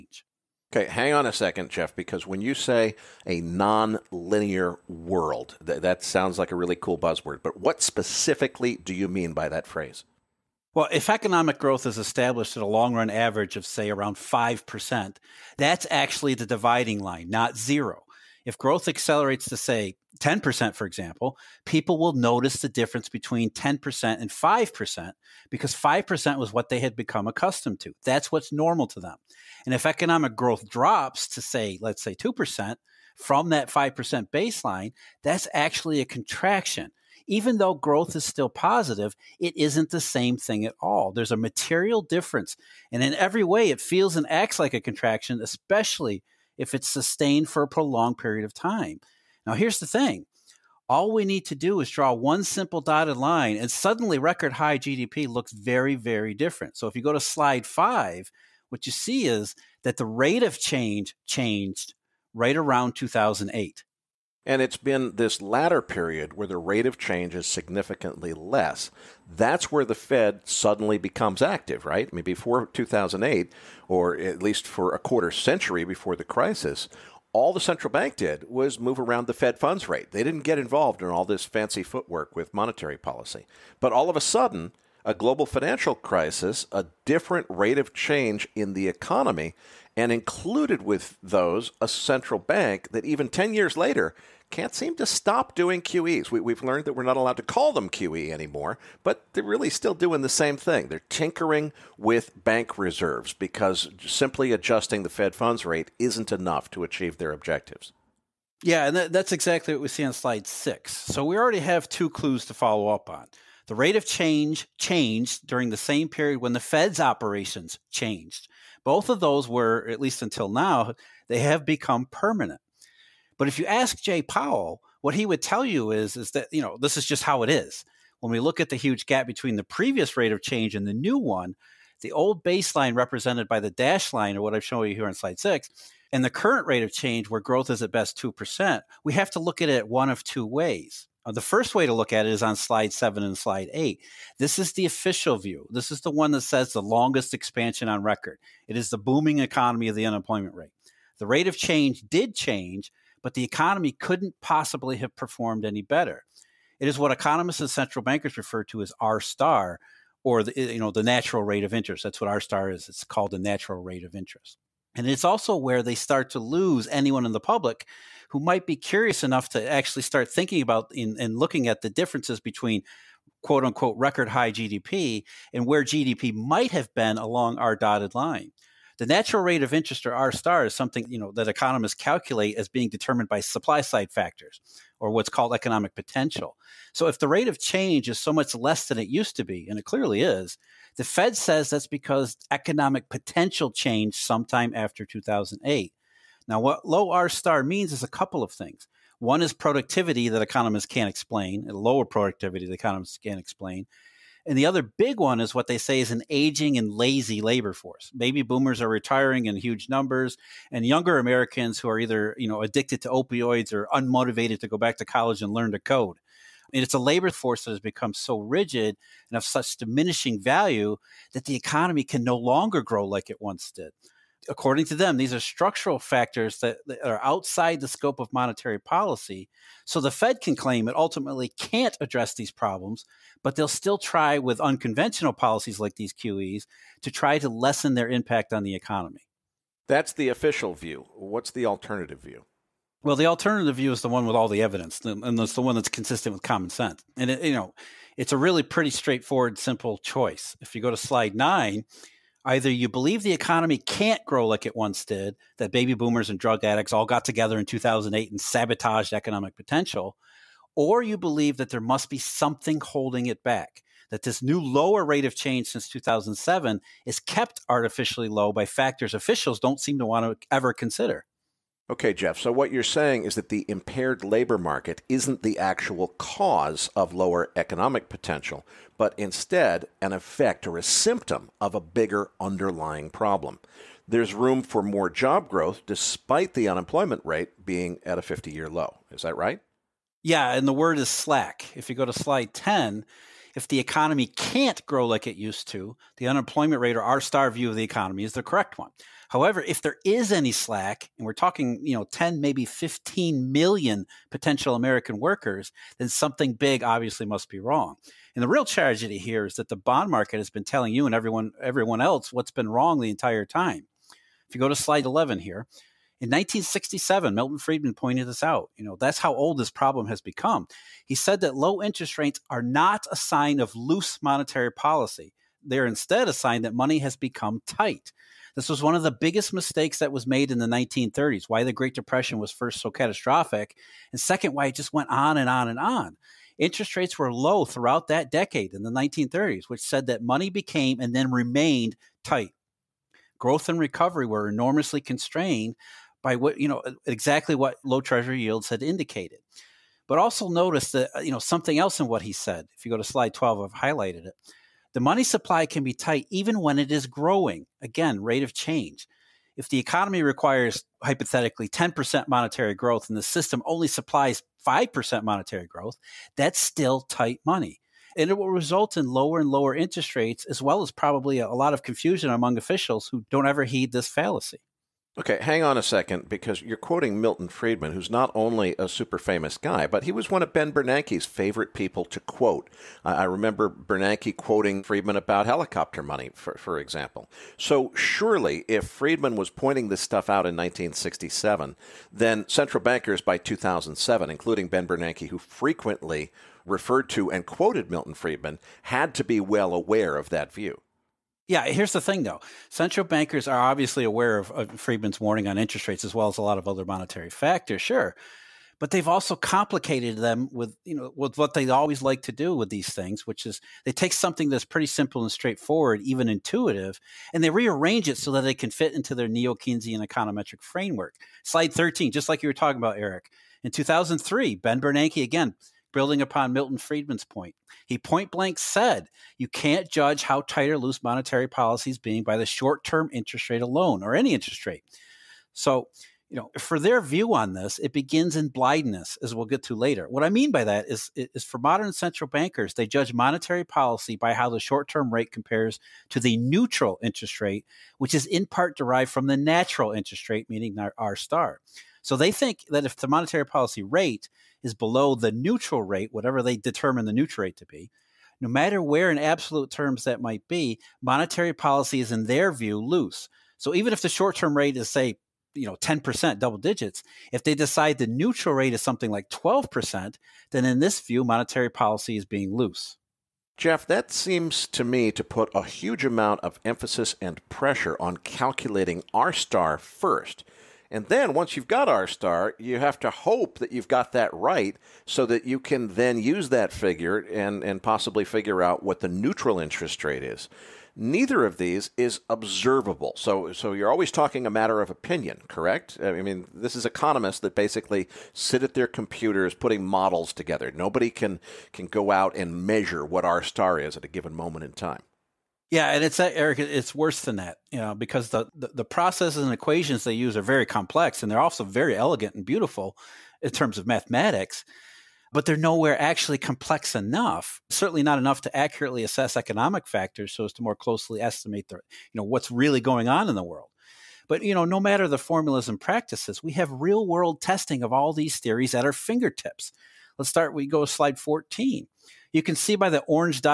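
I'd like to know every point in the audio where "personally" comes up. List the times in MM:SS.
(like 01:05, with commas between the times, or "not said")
not said.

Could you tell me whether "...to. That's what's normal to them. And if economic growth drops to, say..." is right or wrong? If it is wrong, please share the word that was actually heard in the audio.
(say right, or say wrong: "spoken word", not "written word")
right.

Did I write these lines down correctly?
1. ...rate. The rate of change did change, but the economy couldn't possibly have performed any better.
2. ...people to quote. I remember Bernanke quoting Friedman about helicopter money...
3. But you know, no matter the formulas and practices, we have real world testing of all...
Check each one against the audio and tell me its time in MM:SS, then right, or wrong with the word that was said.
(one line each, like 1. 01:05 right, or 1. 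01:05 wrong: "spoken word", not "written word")
1. 02:30 right
2. 06:21 right
3. 08:44 right.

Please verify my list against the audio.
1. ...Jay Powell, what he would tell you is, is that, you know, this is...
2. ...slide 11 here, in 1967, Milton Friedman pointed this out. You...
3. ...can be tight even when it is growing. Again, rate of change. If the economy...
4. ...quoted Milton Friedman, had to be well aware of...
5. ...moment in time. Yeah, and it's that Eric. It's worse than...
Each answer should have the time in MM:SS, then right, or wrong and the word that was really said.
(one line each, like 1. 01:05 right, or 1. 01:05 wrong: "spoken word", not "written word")
1. 02:04 right
2. 05:14 right
3. 05:55 right
4. 06:37 right
5. 08:24 right.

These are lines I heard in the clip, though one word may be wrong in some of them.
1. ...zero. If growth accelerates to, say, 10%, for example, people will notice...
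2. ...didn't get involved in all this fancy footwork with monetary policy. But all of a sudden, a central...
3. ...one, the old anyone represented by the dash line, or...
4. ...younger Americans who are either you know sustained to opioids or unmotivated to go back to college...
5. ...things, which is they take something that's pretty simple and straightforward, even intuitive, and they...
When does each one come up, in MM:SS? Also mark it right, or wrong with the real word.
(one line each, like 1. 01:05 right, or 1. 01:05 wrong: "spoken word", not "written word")
1. 00:17 right
2. 01:20 wrong: "global", not "central"
3. 02:11 wrong: "baseline", not "anyone"
4. 03:30 wrong: "addicted", not "sustained"
5. 06:52 right.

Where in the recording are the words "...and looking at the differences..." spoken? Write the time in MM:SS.
02:50.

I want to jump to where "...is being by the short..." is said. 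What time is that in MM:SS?
07:11.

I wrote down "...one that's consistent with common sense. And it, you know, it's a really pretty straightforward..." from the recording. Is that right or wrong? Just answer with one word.
right.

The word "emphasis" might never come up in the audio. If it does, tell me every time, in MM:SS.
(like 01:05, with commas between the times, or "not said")
07:56.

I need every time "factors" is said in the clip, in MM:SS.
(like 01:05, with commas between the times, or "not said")
03:04, 03:45, 04:28, 06:47, 08:39.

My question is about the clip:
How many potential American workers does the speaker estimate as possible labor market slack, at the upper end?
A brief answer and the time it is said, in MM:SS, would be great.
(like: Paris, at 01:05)
15 million, at 05:02.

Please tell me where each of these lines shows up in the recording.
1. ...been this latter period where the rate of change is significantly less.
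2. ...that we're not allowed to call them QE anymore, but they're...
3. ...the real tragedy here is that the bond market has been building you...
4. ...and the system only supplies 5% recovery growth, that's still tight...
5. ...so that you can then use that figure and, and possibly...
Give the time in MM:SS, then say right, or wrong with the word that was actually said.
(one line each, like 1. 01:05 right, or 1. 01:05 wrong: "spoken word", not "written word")
1. 01:04 right
2. 01:36 right
3. 05:08 wrong: "telling", not "building"
4. 06:03 wrong: "monetary", not "recovery"
5. 08:05 right.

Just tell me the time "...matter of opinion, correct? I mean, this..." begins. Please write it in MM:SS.
08:14.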